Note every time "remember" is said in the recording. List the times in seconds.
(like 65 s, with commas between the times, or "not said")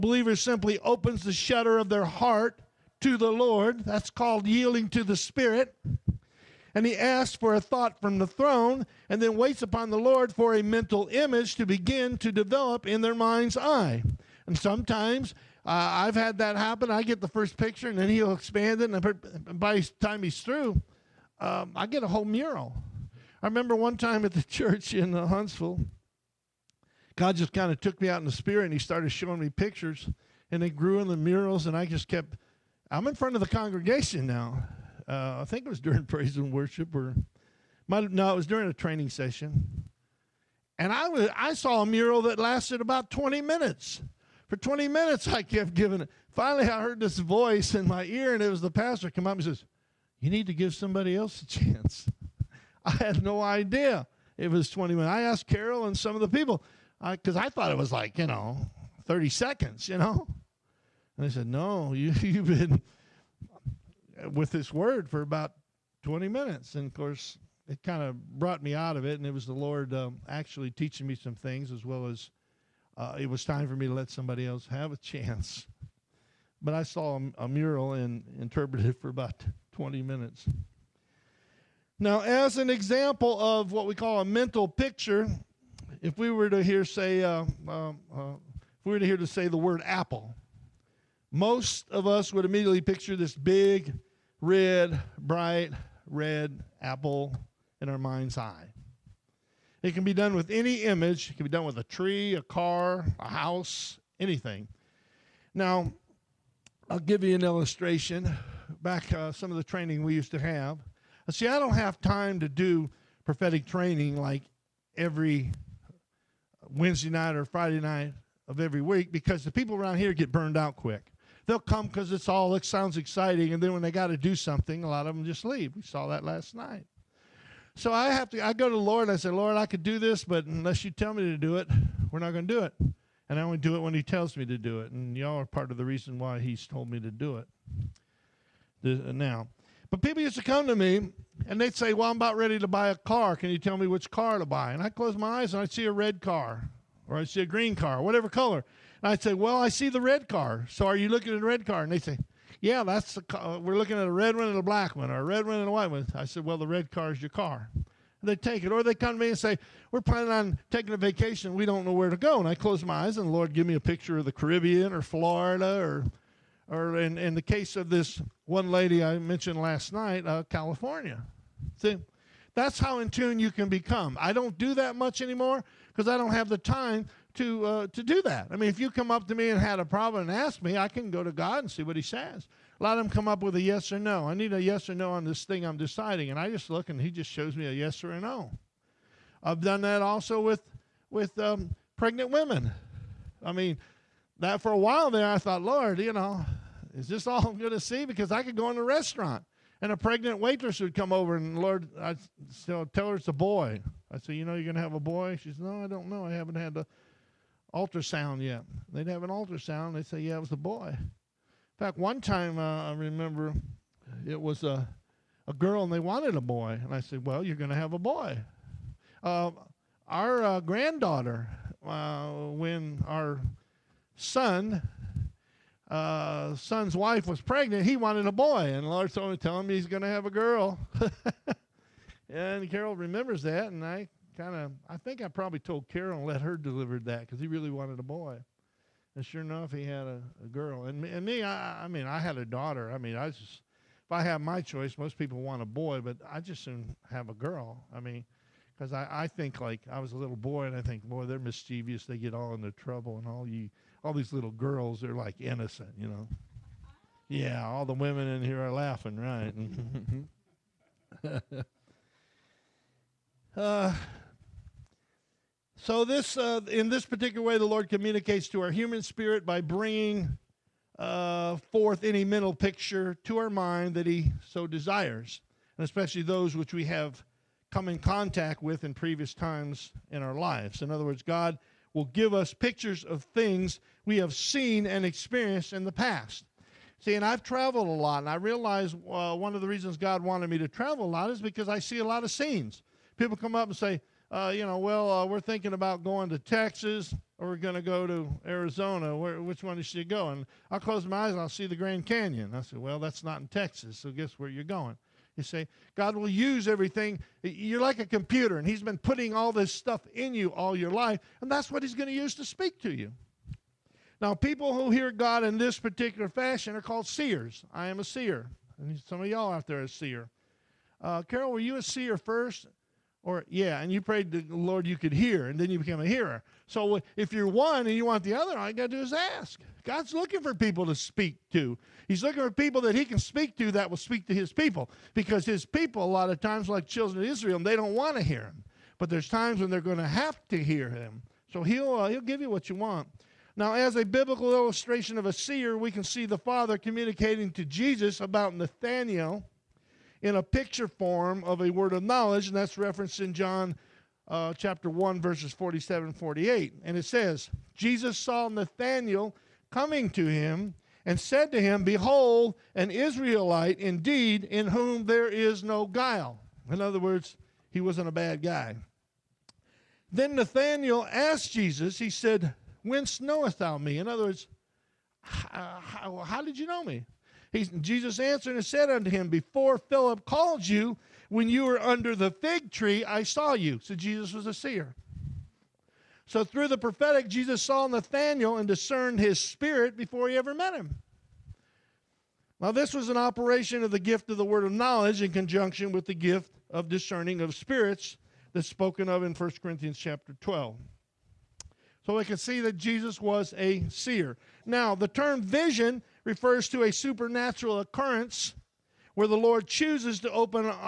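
23 s, 212 s, 232 s.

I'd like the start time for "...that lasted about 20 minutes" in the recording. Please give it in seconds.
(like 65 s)
42 s.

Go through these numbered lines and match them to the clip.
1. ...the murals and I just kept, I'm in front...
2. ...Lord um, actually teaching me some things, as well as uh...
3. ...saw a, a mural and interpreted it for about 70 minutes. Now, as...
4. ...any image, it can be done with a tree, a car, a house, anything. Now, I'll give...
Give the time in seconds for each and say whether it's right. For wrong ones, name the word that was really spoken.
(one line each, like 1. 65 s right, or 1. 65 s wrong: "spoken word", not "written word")
1. 31 s right
2. 69 s right
3. 76 s wrong: "20", not "70"
4. 100 s right.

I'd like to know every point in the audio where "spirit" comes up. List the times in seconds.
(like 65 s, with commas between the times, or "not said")
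5 s, 28 s, 269 s, 389 s, 397 s.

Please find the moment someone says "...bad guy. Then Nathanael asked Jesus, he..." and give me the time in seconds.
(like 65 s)
368 s.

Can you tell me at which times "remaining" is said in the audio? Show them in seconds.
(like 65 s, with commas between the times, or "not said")
not said.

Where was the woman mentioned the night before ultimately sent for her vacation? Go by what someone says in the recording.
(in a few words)
California.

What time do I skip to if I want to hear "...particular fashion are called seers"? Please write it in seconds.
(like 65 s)
315 s.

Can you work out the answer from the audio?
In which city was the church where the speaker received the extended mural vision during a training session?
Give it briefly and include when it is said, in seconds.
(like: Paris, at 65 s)
Huntsville, at 25 s.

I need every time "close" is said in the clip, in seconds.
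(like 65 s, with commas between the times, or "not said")
144 s, 162 s, 300 s.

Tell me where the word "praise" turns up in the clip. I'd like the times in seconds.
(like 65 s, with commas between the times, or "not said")
36 s.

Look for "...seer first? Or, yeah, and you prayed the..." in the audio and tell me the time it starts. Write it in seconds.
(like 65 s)
321 s.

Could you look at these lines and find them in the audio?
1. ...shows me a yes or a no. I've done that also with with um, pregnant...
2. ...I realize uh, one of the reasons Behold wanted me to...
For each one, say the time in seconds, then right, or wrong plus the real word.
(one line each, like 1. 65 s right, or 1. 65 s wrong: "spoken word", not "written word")
1. 187 s right
2. 288 s wrong: "God", not "Behold".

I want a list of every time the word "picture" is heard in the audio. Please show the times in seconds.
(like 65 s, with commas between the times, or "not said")
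17 s, 29 s, 84 s, 92 s, 163 s, 272 s, 282 s, 350 s.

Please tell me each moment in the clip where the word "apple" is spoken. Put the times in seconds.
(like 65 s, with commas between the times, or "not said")
89 s, 96 s.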